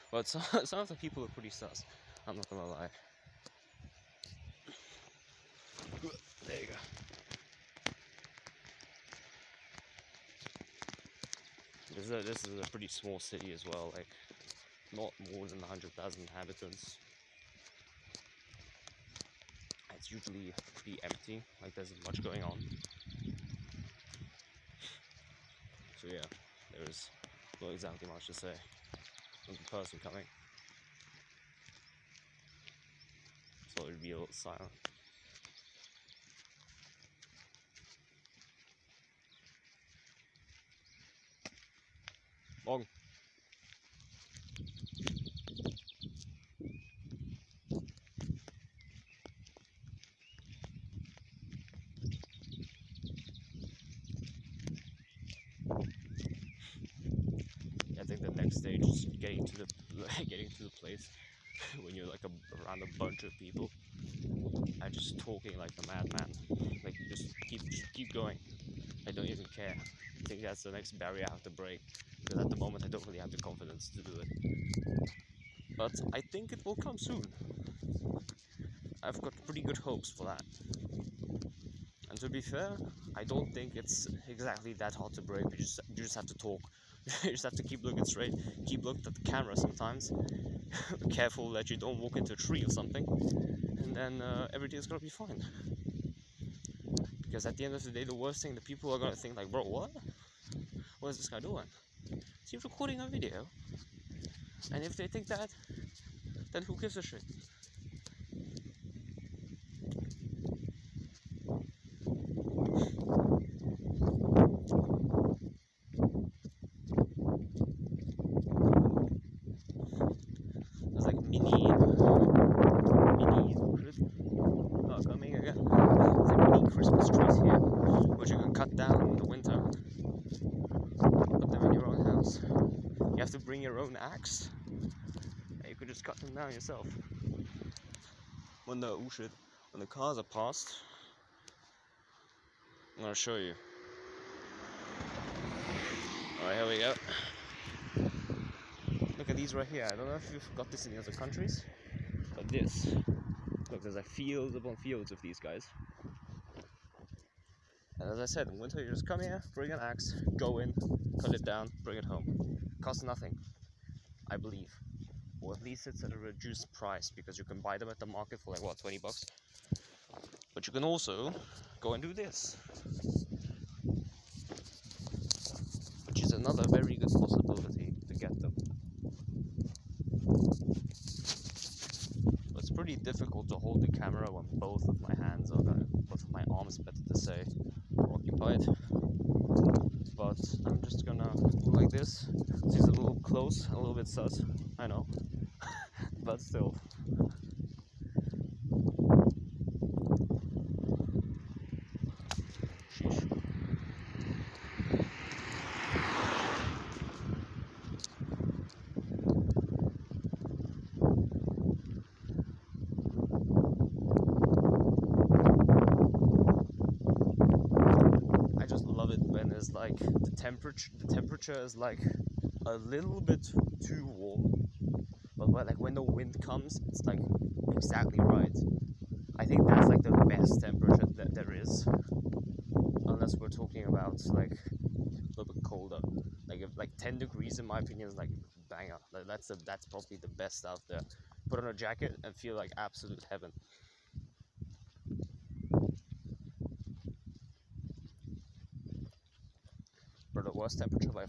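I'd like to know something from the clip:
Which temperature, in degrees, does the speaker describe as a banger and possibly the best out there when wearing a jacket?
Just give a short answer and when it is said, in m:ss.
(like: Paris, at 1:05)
10 degrees, at 3:56.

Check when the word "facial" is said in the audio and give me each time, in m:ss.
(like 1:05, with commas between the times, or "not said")
not said.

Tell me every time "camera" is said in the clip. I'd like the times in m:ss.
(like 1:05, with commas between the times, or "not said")
1:29, 3:03.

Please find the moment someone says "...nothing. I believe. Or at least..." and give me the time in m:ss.
2:43.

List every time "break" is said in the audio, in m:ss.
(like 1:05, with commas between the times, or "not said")
1:11, 1:25.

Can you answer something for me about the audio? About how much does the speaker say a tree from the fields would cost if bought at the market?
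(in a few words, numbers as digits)
20 bucks.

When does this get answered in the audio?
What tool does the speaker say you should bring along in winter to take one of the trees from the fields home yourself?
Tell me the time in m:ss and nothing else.
2:39.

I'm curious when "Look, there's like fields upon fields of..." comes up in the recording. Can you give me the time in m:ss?
2:33.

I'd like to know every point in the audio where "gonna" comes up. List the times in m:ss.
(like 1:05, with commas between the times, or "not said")
0:02, 1:34, 1:38, 2:23, 3:11.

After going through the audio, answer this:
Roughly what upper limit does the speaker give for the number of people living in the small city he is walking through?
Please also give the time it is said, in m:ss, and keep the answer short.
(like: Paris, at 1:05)
100,000, at 0:15.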